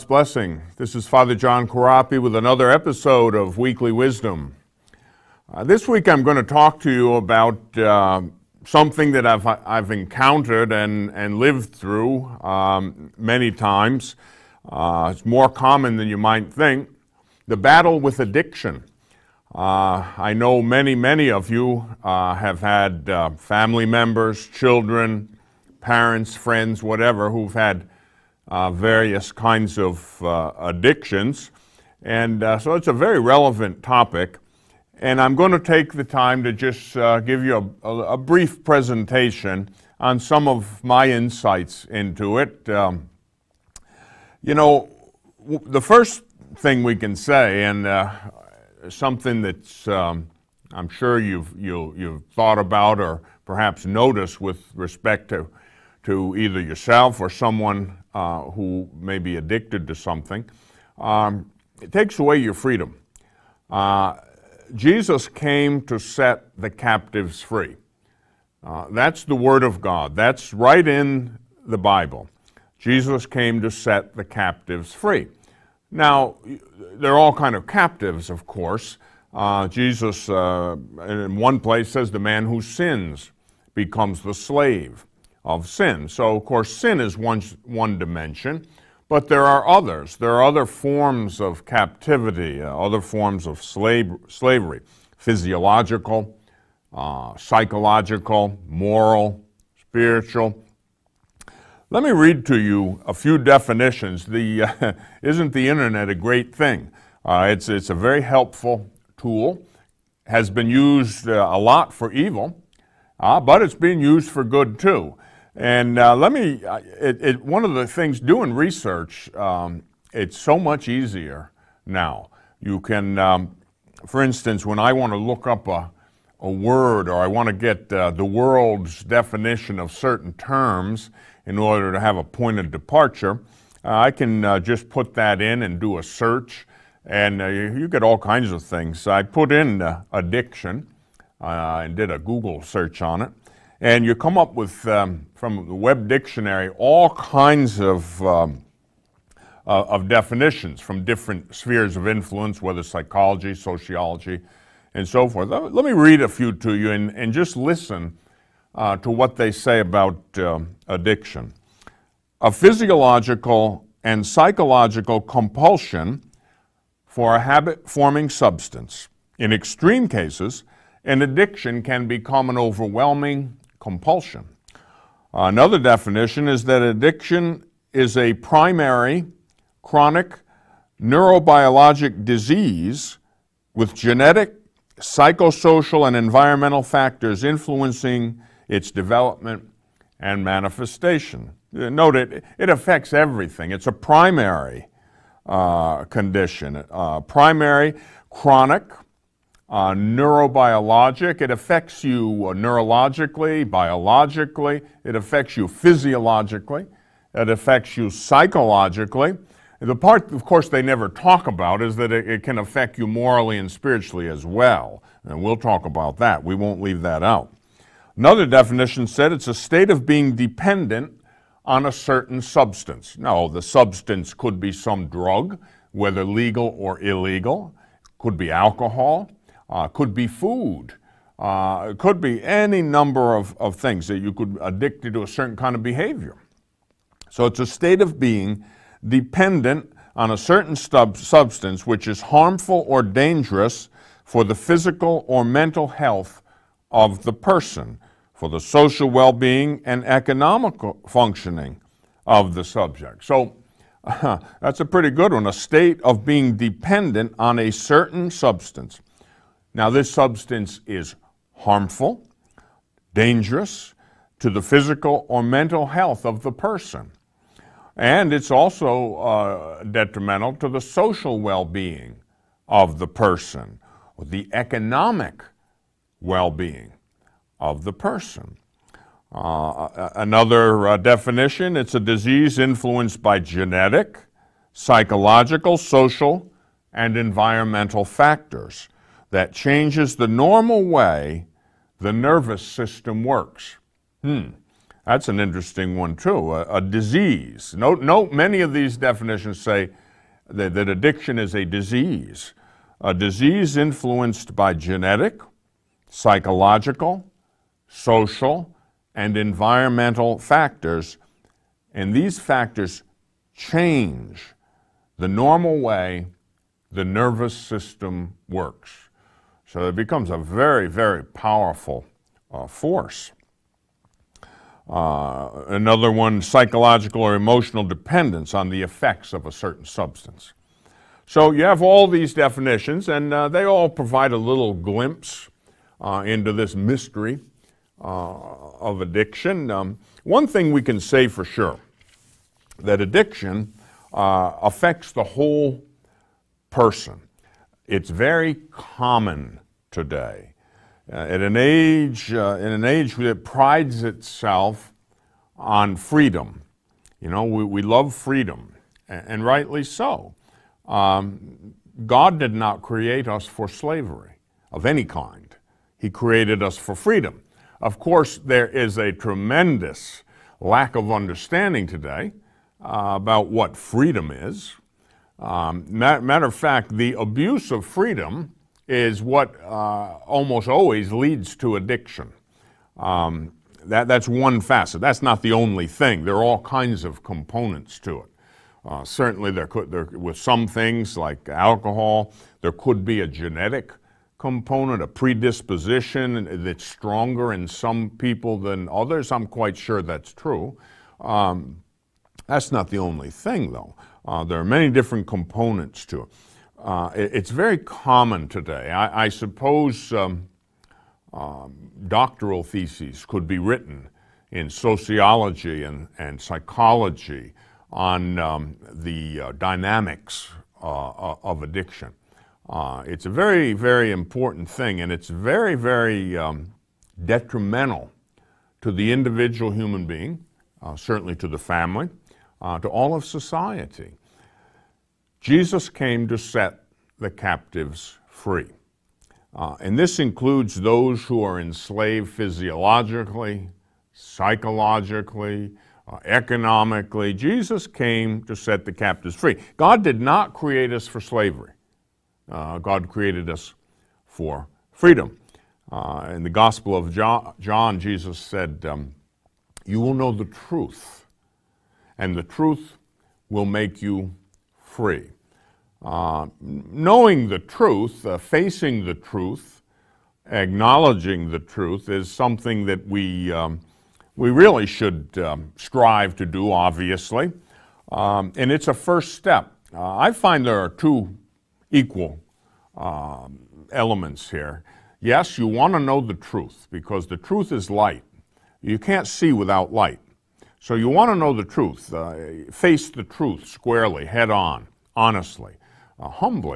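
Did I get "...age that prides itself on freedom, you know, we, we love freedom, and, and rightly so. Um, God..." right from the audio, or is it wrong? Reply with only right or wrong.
right.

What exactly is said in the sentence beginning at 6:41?
Um, that's not the only thing, though.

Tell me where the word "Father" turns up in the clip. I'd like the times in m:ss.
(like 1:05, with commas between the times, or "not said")
0:01.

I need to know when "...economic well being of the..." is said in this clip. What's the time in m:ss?
4:34.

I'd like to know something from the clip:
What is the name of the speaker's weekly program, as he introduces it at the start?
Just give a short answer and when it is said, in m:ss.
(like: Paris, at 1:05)
Weekly Wisdom, at 0:03.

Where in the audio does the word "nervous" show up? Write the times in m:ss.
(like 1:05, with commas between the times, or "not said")
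4:52, 5:17.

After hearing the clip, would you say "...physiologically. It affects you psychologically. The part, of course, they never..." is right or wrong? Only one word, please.
right.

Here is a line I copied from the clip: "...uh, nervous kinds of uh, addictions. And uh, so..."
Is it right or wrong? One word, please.
wrong.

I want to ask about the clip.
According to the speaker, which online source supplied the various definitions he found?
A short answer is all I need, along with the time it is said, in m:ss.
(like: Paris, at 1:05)
web dictionary, at 2:25.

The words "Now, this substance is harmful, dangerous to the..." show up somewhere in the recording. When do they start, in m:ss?
4:19.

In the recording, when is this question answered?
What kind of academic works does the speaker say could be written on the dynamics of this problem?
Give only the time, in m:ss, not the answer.
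6:52.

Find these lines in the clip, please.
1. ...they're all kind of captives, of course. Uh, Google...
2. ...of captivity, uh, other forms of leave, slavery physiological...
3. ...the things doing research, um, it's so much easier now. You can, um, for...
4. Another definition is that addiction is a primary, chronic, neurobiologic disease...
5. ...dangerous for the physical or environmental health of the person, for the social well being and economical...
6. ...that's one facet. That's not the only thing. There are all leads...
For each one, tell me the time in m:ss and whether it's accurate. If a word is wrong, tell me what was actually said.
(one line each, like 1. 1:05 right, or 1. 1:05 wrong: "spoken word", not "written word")
1. 1:16 wrong: "Jesus", not "Google"
2. 1:31 wrong: "slave", not "leave"
3. 1:57 right
4. 2:55 right
5. 4:03 wrong: "mental", not "environmental"
6. 6:24 wrong: "kinds", not "leads".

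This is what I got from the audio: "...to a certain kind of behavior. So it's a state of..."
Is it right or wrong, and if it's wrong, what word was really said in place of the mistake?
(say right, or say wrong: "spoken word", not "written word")
right.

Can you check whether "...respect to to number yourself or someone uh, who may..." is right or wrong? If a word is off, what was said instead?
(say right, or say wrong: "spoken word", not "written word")
wrong: "either", not "number".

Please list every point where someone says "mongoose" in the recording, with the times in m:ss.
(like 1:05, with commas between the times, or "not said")
not said.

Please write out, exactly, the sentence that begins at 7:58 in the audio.
Um, and it's a first step.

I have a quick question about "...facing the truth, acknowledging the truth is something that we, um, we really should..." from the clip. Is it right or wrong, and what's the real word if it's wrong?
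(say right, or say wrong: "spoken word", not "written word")
right.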